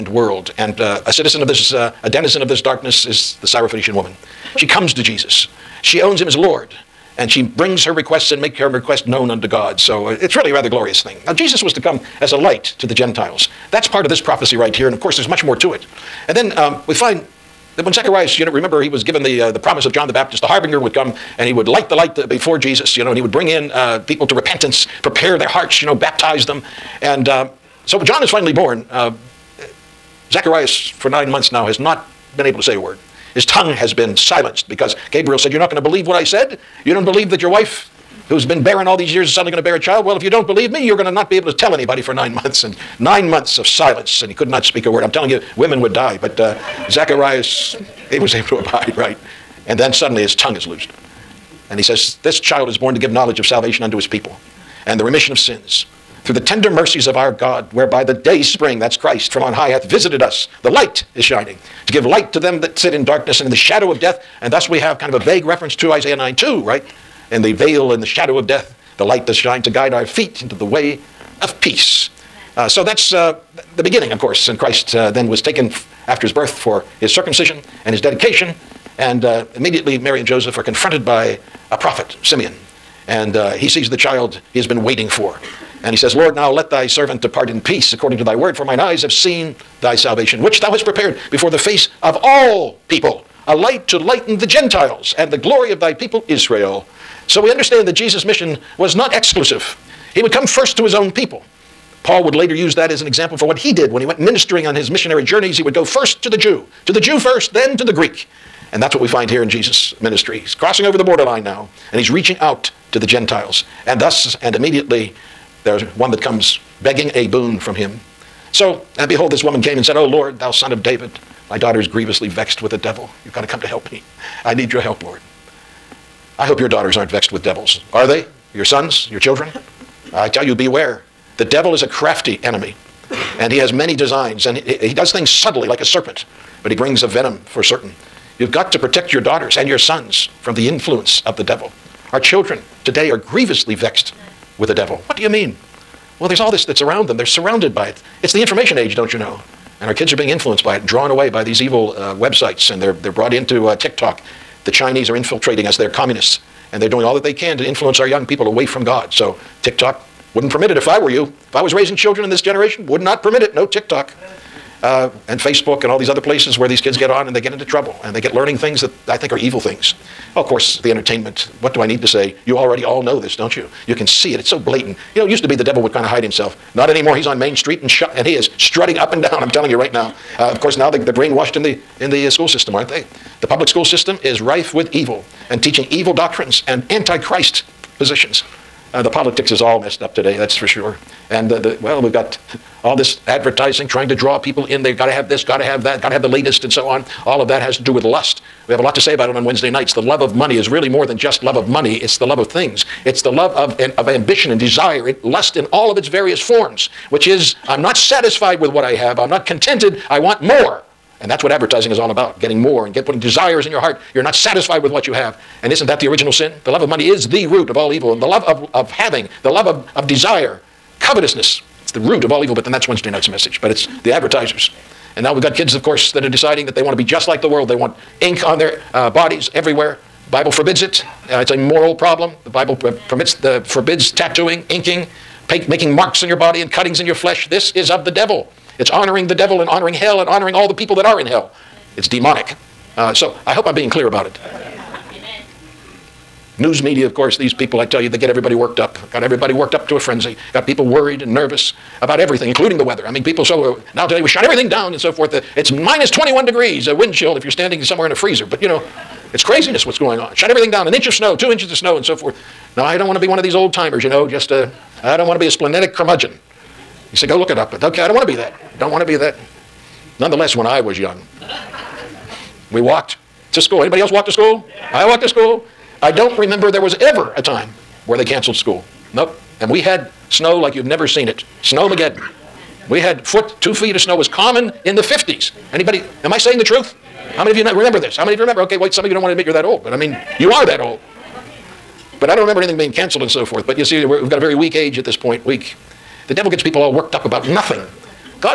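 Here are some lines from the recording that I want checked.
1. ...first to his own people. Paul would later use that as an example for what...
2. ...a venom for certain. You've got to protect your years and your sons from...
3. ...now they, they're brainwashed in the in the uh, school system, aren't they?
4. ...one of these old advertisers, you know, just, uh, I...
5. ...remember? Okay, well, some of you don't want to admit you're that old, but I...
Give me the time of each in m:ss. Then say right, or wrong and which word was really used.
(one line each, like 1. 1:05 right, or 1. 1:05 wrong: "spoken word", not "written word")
1. 1:40 right
2. 2:17 wrong: "daughters", not "years"
3. 3:00 right
4. 4:23 wrong: "timers", not "advertisers"
5. 4:48 right.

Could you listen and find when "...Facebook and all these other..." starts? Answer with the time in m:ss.
2:45.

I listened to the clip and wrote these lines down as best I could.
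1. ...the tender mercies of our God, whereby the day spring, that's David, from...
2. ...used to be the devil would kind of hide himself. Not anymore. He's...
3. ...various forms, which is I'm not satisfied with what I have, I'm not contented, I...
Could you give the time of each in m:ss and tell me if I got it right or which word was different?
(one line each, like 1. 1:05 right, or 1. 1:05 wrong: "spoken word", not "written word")
1. 0:56 wrong: "Christ", not "David"
2. 2:55 right
3. 3:26 right.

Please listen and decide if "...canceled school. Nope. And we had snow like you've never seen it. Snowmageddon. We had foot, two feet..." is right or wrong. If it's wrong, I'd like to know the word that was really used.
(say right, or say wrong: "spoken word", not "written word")
right.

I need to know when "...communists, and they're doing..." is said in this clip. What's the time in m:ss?
2:35.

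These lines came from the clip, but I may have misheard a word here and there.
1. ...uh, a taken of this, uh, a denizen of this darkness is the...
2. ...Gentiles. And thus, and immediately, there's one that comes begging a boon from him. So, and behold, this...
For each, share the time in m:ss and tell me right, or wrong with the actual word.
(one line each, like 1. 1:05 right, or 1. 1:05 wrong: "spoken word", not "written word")
1. 0:00 wrong: "citizen", not "taken"
2. 1:53 right.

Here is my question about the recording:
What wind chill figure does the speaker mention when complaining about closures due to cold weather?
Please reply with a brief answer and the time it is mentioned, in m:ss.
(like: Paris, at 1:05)
-21 degrees, at 4:15.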